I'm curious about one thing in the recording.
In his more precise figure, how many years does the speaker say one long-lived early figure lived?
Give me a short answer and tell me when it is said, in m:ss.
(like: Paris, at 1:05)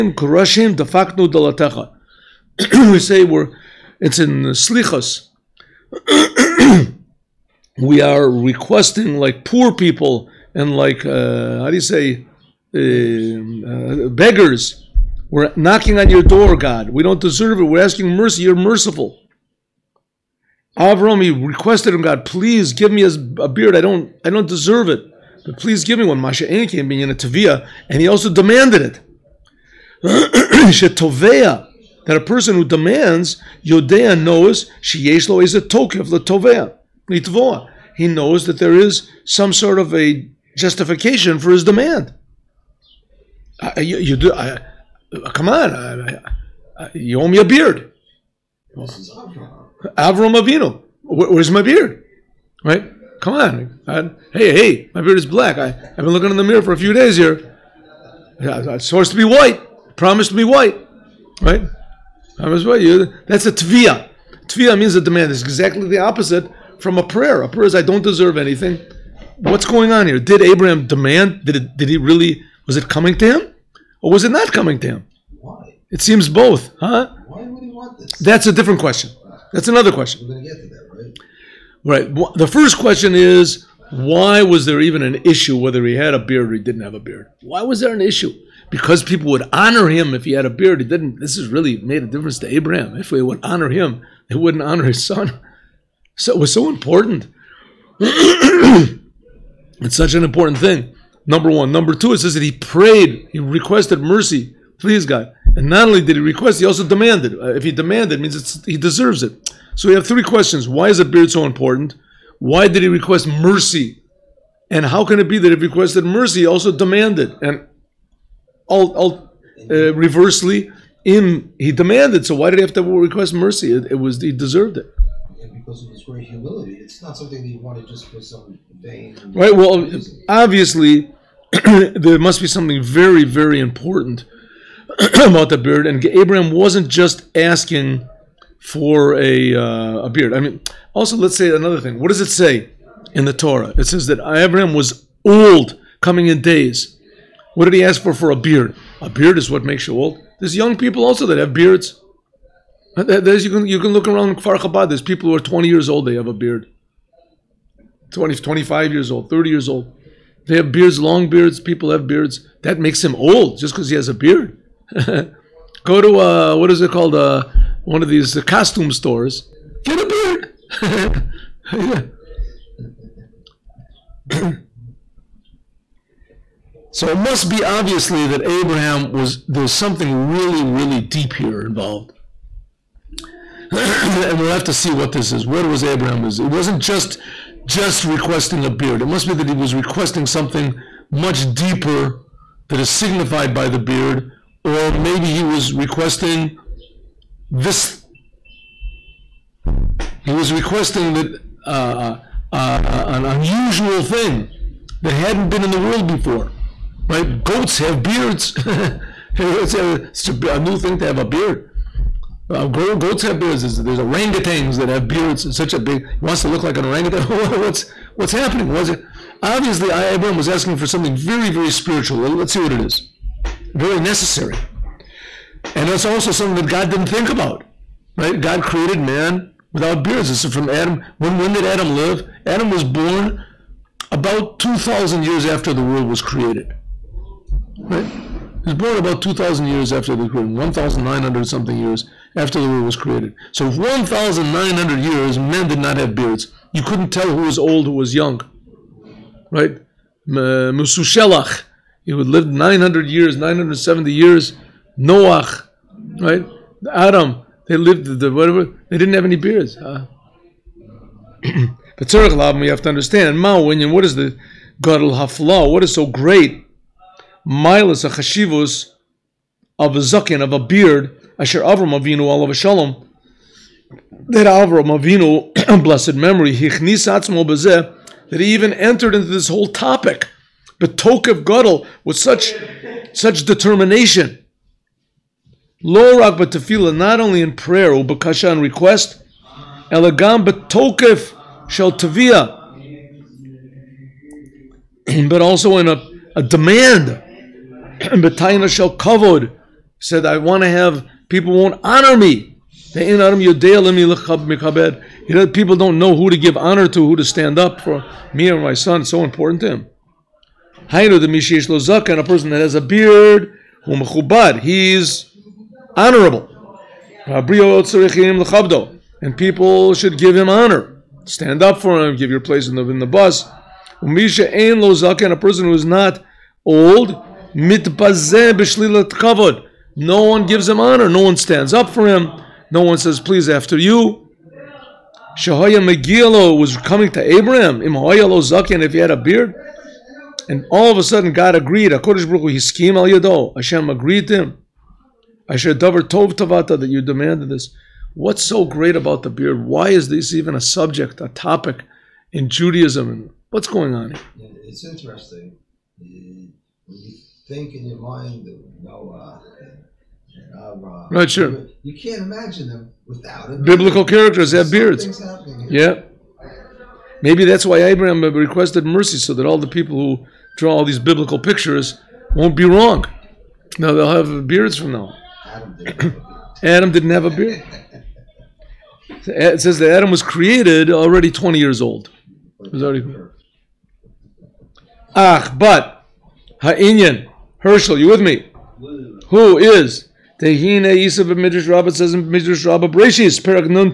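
970, at 4:13.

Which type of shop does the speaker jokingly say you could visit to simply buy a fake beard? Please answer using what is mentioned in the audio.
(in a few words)
costume stores.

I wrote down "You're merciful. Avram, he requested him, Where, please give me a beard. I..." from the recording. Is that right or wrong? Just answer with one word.
wrong.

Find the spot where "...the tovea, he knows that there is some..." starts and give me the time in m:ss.
0:36.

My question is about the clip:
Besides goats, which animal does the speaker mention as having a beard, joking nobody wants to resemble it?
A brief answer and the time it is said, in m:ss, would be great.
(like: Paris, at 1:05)
orangutans, at 3:33.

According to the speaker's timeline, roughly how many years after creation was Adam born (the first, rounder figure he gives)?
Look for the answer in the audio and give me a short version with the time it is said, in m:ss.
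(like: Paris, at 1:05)
2,000, at 3:54.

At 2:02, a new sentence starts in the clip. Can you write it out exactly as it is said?
So why did he have to request mercy?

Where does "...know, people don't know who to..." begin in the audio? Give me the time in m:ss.
5:03.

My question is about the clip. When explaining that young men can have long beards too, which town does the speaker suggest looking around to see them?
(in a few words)
Kfar Chabad.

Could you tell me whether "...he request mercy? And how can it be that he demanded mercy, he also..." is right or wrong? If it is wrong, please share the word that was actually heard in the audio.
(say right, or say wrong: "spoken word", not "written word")
wrong: "requested", not "demanded".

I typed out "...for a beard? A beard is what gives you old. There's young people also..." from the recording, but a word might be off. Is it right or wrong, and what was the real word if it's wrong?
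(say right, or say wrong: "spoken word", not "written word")
wrong: "makes", not "gives".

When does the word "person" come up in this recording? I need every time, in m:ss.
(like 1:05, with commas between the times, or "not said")
0:32, 5:12, 5:25.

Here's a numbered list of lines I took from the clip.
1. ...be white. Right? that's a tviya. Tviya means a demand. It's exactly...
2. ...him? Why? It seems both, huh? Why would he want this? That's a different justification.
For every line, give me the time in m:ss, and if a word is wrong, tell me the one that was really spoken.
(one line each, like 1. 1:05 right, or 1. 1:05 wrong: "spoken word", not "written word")
1. 1:00 right
2. 1:14 wrong: "question", not "justification".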